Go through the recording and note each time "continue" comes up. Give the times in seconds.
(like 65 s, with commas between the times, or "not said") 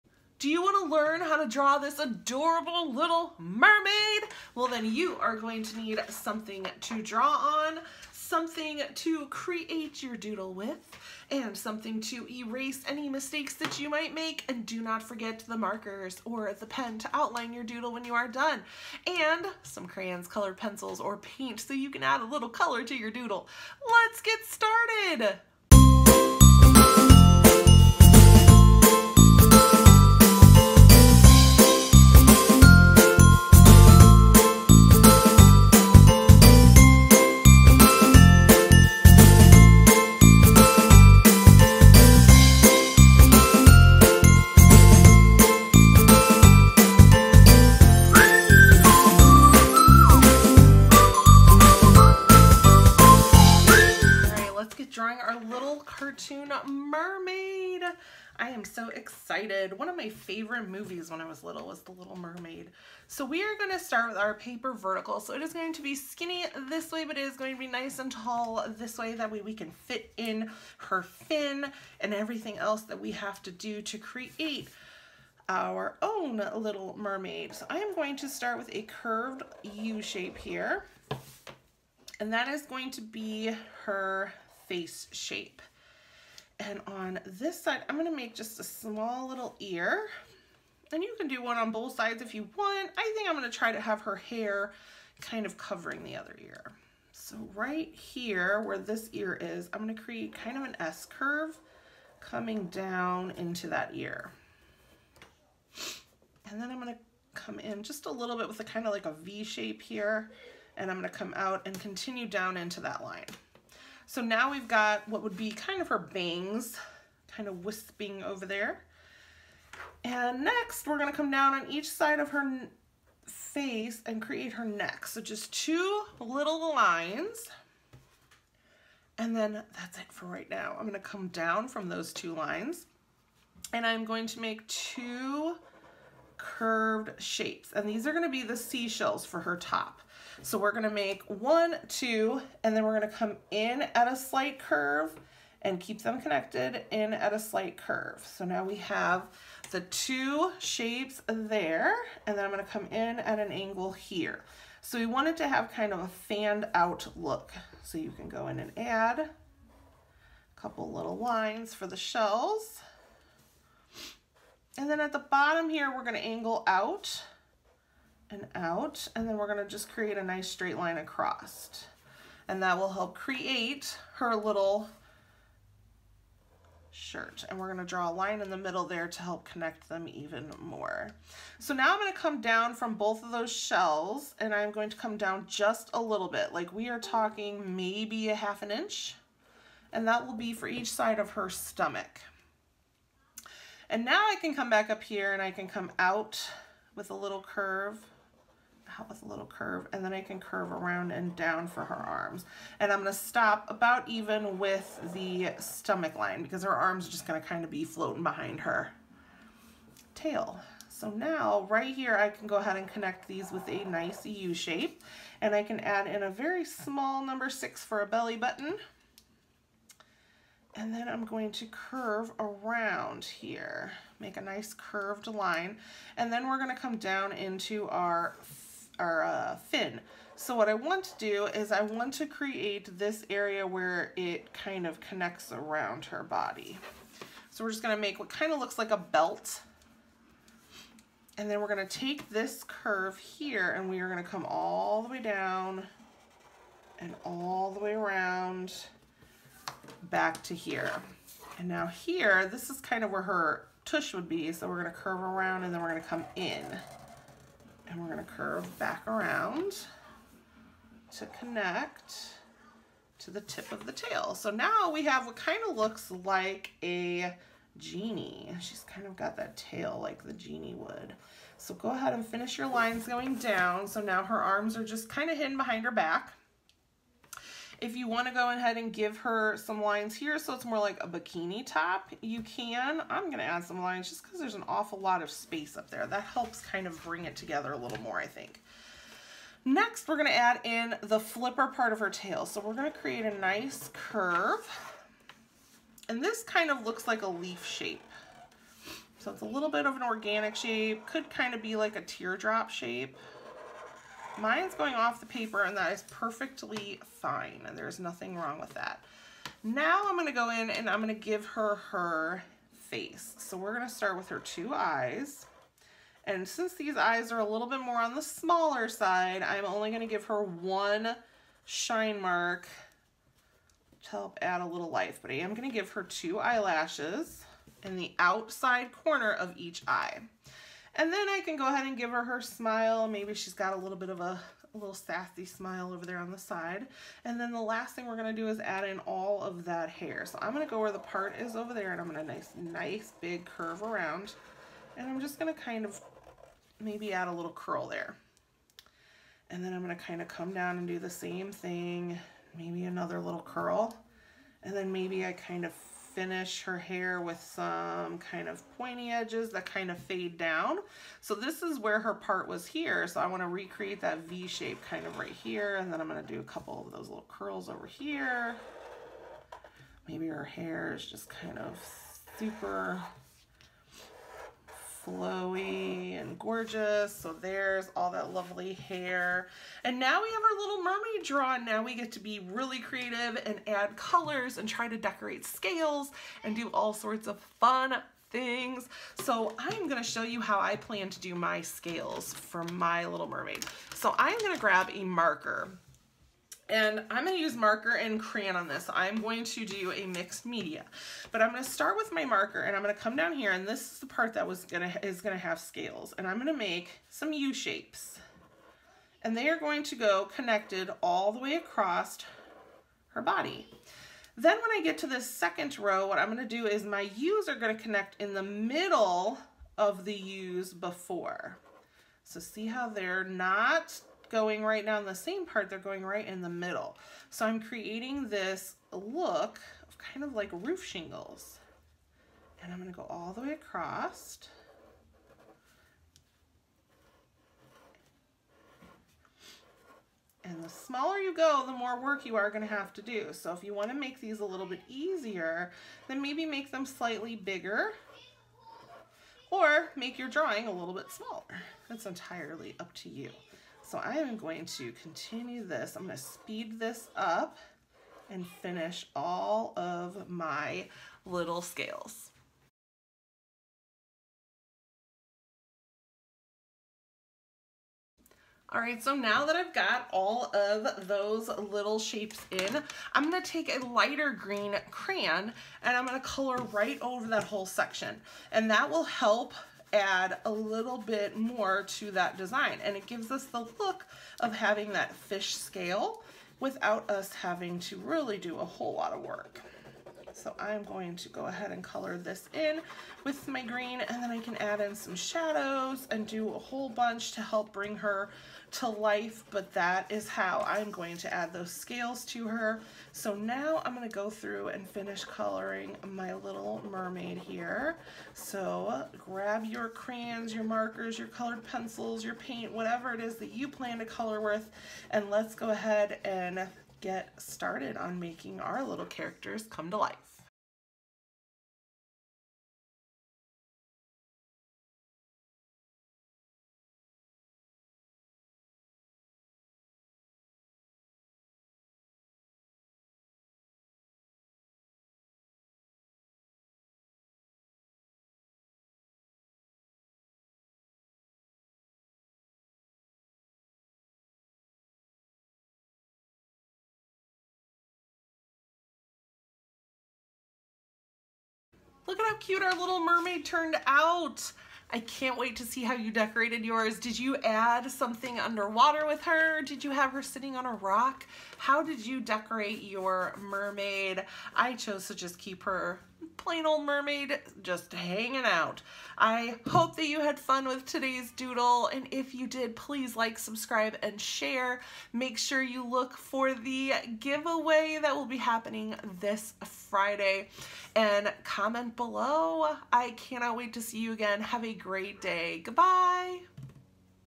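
111 s, 455 s.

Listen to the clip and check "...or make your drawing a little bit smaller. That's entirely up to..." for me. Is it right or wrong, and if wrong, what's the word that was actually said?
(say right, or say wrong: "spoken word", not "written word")
right.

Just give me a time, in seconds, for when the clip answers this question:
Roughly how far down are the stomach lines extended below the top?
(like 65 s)
188 s.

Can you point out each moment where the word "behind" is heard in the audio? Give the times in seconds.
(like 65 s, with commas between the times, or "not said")
208 s, 275 s.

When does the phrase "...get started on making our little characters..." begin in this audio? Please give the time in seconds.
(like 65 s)
517 s.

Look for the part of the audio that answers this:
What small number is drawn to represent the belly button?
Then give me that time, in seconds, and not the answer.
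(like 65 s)
217 s.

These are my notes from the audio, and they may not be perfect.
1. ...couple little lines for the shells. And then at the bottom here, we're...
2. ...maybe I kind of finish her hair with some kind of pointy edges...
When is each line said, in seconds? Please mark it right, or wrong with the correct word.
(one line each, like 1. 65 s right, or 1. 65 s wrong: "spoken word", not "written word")
1. 160 s right
2. 354 s right.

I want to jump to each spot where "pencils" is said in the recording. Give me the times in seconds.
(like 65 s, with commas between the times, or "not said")
20 s, 511 s.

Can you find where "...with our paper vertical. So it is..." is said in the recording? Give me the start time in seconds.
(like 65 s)
64 s.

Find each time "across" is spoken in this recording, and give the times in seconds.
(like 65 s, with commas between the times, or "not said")
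170 s, 411 s, 433 s.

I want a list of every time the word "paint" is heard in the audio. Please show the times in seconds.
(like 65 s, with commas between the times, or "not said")
21 s, 512 s.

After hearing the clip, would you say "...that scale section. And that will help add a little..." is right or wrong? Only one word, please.
wrong.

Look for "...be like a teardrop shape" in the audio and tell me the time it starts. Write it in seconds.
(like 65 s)
301 s.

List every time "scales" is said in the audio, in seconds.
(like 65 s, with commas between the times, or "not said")
385 s, 391 s, 405 s, 461 s, 485 s, 501 s.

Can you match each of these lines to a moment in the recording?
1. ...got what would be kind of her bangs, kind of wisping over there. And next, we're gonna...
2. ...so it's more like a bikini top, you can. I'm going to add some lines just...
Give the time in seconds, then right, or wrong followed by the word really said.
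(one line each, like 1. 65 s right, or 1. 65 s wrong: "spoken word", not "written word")
1. 114 s right
2. 280 s right.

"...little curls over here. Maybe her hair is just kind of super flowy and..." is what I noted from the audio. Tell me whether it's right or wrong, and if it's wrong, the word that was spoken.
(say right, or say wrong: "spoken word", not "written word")
right.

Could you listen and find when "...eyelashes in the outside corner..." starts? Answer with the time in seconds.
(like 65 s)
326 s.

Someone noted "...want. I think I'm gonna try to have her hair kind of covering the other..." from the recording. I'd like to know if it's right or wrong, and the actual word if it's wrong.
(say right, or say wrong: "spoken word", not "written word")
right.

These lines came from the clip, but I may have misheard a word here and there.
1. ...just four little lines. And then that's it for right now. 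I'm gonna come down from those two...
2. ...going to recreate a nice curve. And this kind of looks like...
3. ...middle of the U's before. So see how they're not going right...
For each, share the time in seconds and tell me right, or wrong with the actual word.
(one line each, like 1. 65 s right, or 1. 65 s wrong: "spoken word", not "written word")
1. 125 s wrong: "two", not "four"
2. 292 s wrong: "create", not "recreate"
3. 418 s right.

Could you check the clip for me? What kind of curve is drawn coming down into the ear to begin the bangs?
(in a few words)
S curve.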